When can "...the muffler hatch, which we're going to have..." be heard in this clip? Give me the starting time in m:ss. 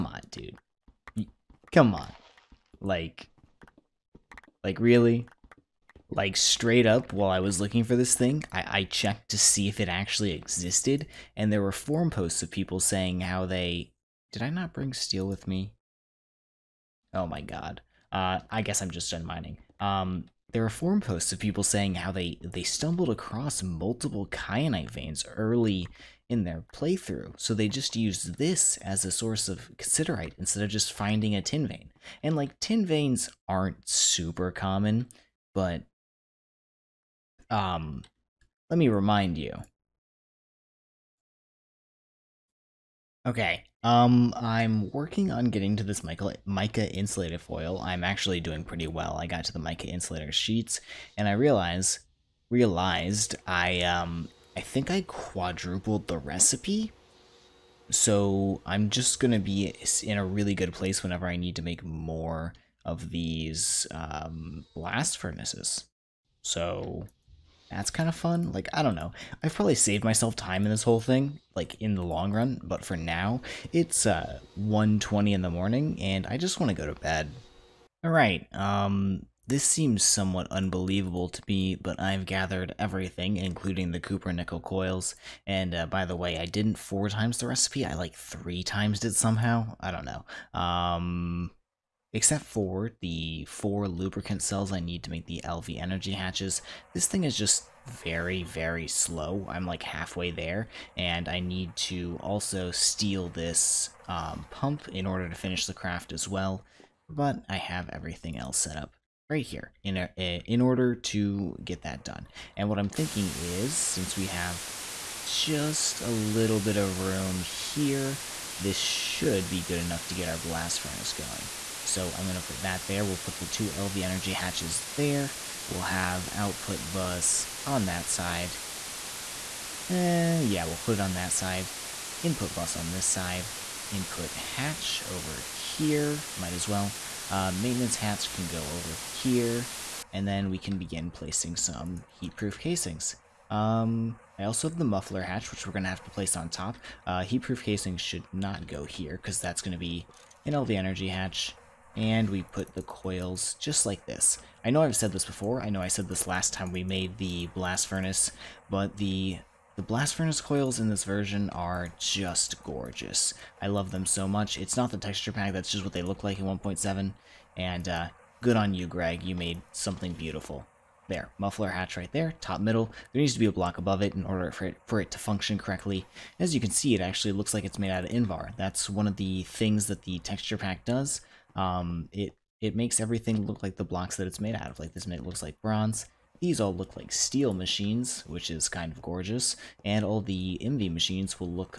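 2:24.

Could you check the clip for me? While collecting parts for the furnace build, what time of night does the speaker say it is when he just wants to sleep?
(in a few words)
1:20.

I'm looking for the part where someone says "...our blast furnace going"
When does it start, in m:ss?
2:00.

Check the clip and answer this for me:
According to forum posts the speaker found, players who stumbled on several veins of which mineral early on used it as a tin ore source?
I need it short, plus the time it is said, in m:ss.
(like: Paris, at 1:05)
Kyanite, at 0:24.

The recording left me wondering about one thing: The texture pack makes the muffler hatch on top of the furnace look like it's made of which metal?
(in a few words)
Invar.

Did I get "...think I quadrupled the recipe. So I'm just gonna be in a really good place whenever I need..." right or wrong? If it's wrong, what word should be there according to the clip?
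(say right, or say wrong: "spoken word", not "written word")
right.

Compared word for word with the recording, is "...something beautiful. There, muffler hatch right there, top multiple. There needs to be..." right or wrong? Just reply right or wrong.
wrong.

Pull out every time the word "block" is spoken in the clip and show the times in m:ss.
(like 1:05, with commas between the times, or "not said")
2:53, 3:03.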